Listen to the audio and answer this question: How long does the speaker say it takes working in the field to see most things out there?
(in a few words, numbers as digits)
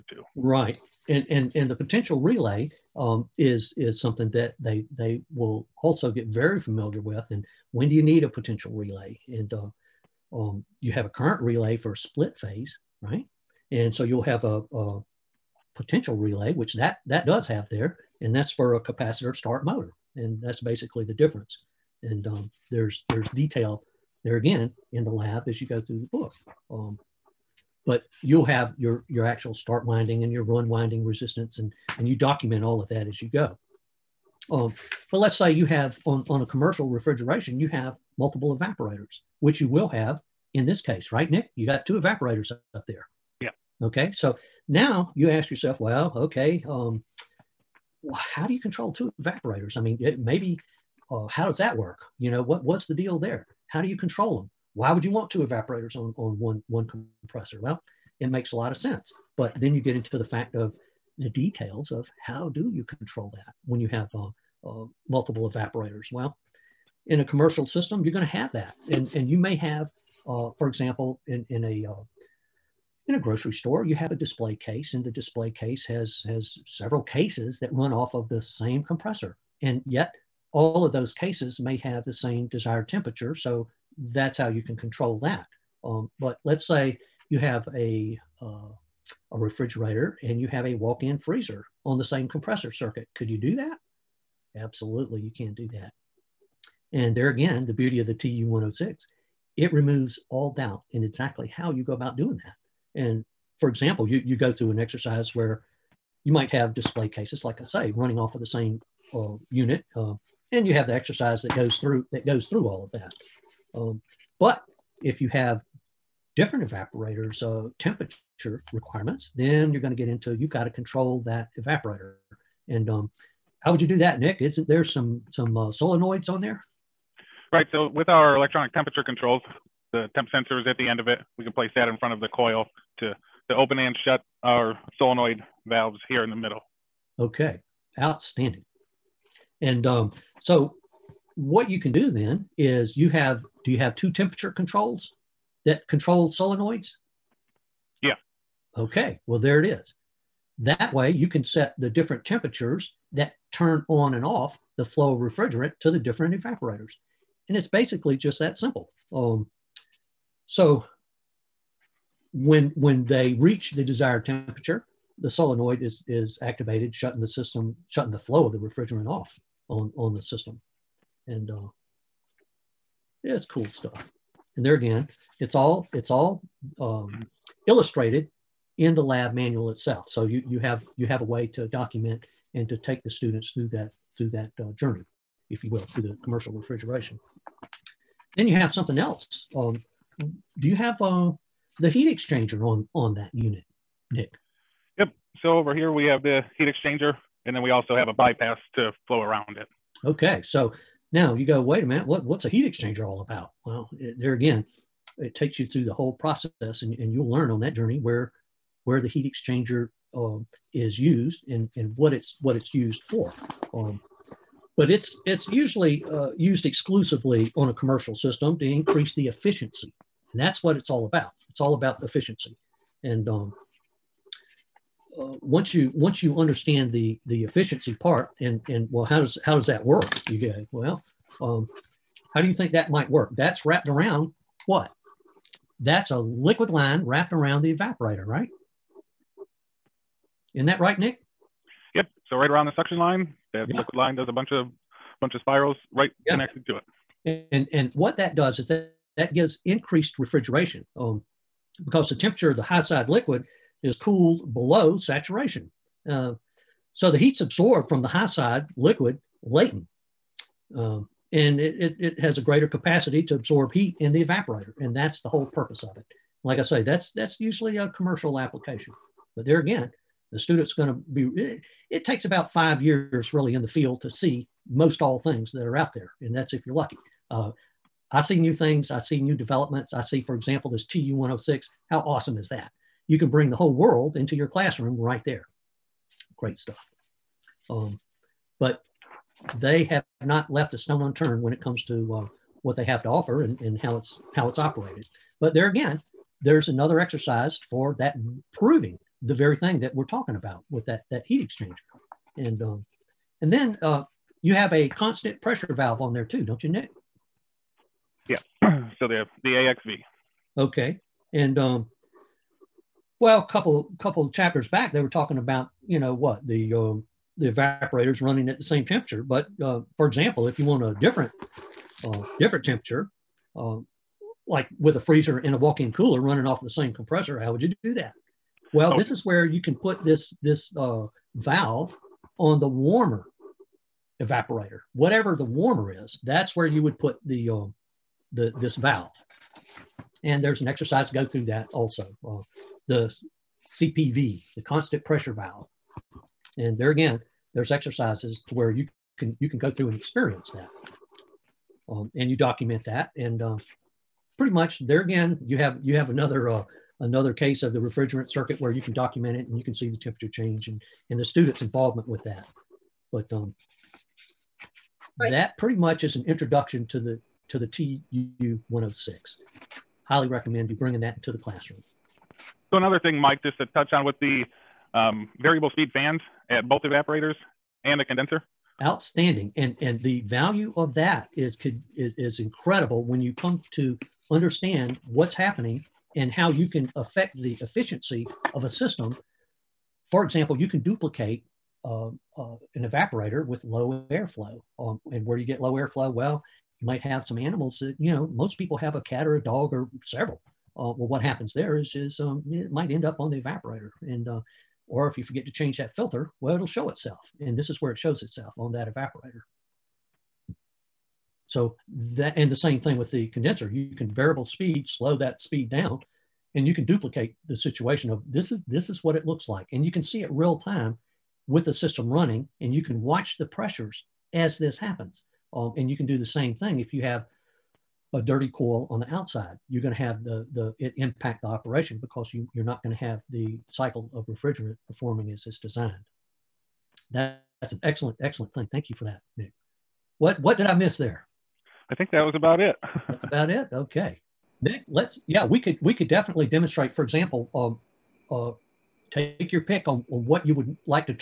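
About five years.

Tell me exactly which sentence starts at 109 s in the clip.
Uh, and you have the exercise that goes through that goes through all of that.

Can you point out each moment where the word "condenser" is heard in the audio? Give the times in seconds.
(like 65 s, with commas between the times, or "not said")
378 s, 413 s.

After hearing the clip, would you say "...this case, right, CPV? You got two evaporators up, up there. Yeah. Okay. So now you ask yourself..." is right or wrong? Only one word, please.
wrong.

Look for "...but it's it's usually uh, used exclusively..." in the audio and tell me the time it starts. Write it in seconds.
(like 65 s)
214 s.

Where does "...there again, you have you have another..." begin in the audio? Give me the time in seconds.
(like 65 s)
354 s.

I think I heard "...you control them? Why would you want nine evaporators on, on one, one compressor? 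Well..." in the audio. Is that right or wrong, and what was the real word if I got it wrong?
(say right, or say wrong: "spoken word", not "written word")
wrong: "two", not "nine".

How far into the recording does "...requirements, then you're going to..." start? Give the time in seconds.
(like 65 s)
118 s.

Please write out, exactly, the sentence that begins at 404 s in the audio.
And, uh, or if you forget to change that filter, well, it'll show itself.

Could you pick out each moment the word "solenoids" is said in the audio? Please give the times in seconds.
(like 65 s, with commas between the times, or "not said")
125 s, 134 s, 146 s, 165 s.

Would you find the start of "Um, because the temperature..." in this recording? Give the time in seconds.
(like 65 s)
250 s.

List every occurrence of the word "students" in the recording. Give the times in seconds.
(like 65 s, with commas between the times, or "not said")
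183 s, 270 s, 361 s.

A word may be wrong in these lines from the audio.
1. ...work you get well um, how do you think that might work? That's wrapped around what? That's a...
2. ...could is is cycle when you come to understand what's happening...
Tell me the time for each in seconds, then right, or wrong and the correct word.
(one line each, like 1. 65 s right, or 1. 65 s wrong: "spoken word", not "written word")
1. 229 s right
2. 381 s wrong: "incredible", not "cycle".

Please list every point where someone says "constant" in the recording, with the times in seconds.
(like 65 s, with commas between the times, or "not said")
304 s, 344 s.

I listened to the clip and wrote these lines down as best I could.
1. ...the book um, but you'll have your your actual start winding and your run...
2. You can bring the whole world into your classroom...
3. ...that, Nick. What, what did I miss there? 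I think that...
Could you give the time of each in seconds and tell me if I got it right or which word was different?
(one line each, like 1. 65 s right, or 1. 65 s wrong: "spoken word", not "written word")
1. 26 s right
2. 283 s right
3. 439 s right.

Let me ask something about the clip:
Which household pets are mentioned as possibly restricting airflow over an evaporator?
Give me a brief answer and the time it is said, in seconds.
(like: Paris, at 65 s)
A cat or a dog, at 398 s.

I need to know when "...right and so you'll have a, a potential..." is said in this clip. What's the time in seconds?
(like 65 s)
13 s.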